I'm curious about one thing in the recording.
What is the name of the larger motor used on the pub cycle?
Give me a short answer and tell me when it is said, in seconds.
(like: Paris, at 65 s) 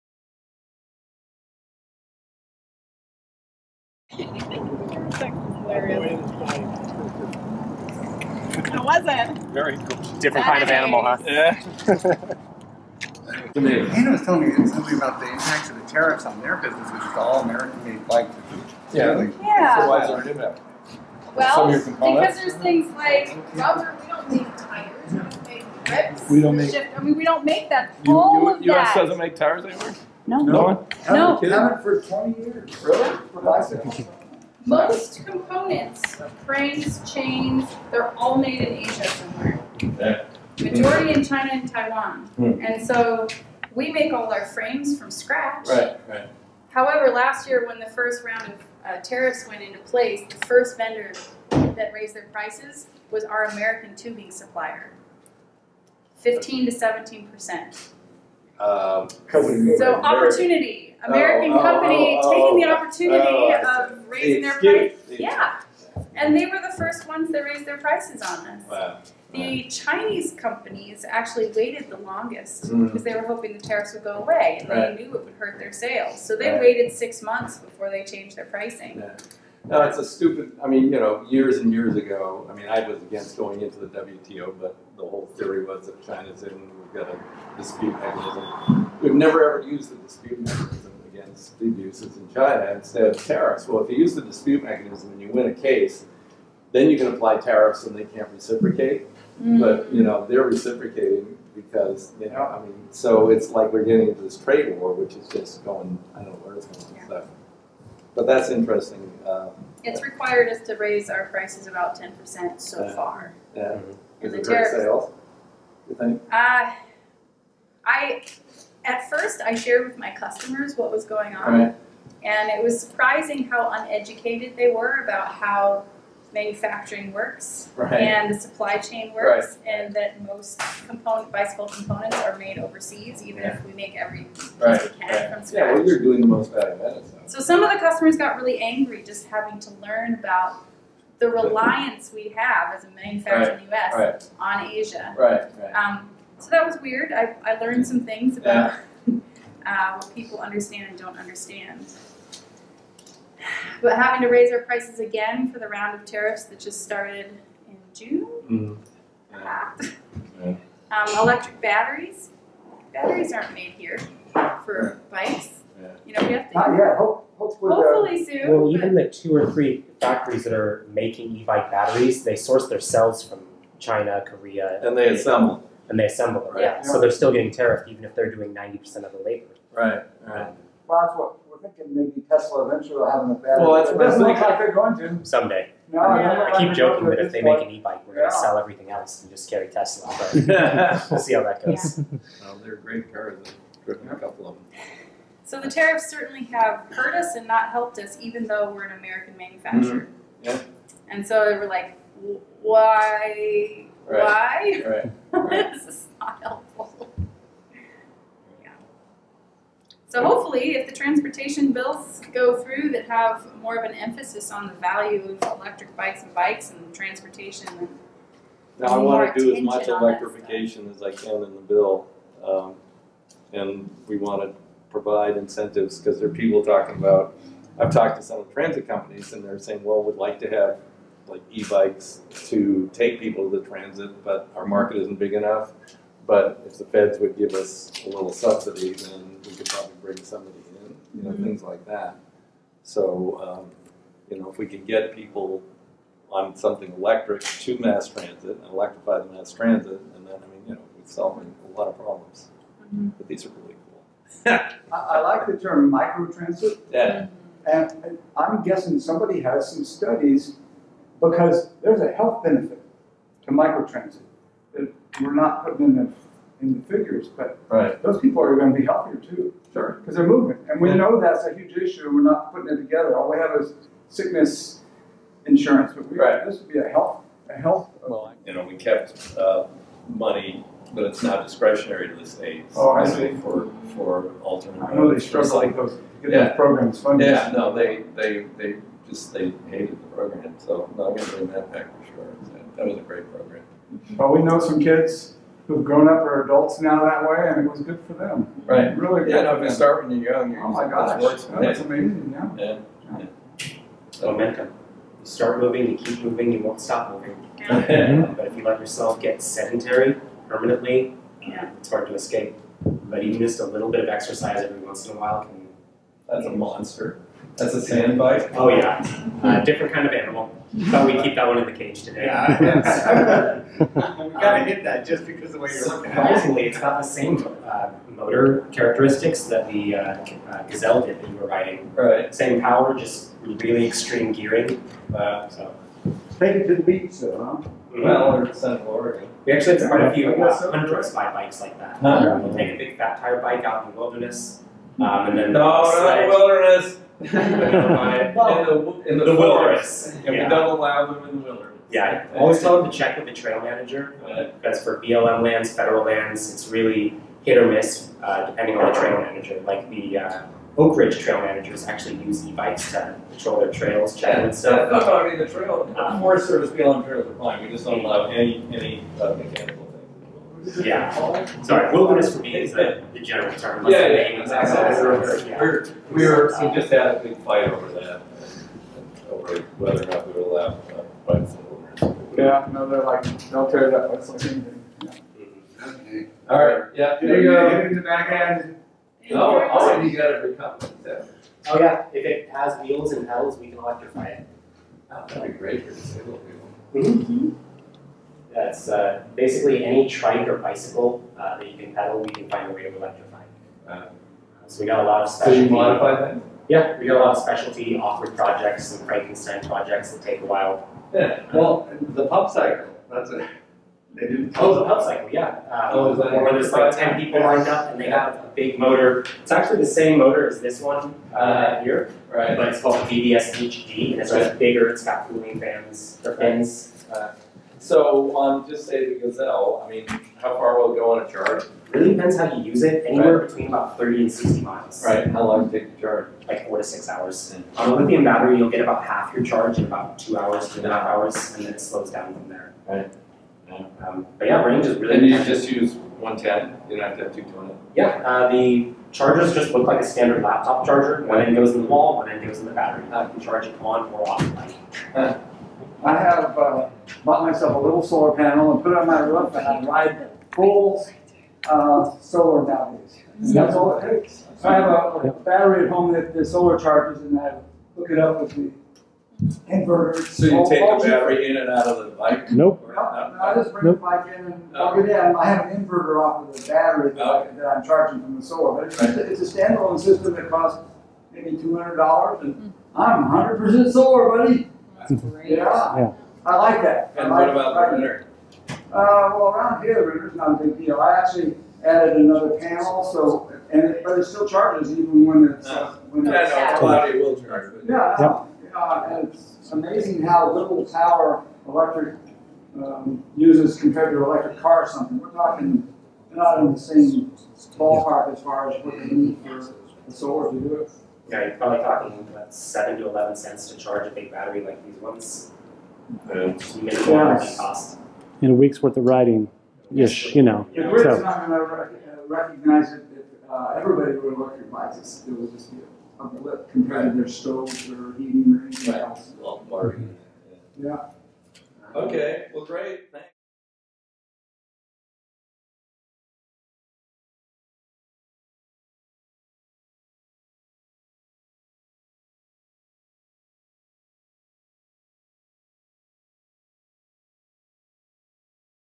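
BBS HD, at 423 s.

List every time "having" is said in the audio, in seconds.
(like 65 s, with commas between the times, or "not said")
139 s, 153 s.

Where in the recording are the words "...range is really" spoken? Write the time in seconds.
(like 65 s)
444 s.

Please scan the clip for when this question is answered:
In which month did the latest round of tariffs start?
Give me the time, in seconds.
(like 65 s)
157 s.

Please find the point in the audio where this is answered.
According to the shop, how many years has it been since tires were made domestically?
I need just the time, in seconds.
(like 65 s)
32 s.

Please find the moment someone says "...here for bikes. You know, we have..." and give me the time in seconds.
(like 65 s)
163 s.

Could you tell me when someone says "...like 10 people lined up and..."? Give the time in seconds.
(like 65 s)
416 s.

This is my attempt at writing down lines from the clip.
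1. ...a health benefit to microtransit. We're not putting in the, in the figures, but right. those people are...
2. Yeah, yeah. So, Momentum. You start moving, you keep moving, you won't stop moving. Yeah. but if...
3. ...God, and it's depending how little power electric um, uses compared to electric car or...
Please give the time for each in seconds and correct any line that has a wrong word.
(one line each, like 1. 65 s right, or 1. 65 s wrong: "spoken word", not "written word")
1. 262 s right
2. 302 s right
3. 498 s wrong: "amazing", not "depending".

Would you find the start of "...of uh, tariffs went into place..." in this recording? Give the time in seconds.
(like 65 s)
48 s.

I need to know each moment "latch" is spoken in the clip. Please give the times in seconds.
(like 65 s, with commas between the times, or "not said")
not said.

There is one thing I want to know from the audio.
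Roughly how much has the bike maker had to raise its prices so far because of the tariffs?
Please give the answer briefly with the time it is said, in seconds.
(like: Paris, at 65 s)
10 percent, at 111 s.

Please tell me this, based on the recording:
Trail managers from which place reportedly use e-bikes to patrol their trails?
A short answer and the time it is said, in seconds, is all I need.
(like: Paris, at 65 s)
Oakridge, at 360 s.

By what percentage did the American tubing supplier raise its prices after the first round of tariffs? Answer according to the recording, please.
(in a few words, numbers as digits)
15 to 17 percent.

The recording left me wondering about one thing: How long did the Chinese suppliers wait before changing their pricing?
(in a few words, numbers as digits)
6 months.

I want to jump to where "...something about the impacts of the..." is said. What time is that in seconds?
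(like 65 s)
14 s.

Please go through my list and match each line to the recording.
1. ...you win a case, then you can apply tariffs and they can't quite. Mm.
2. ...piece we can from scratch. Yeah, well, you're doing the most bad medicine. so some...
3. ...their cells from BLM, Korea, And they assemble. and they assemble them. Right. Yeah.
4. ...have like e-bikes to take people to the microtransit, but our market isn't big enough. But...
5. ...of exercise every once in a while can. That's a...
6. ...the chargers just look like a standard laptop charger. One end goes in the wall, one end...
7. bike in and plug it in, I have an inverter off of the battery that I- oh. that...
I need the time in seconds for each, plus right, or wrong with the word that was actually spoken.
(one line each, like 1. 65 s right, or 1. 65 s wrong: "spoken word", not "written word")
1. 95 s wrong: "reciprocate", not "quite"
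2. 134 s right
3. 172 s wrong: "China", not "BLM"
4. 230 s wrong: "transit", not "microtransit"
5. 314 s right
6. 448 s right
7. 474 s right.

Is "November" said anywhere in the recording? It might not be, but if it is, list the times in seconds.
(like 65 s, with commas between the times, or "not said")
not said.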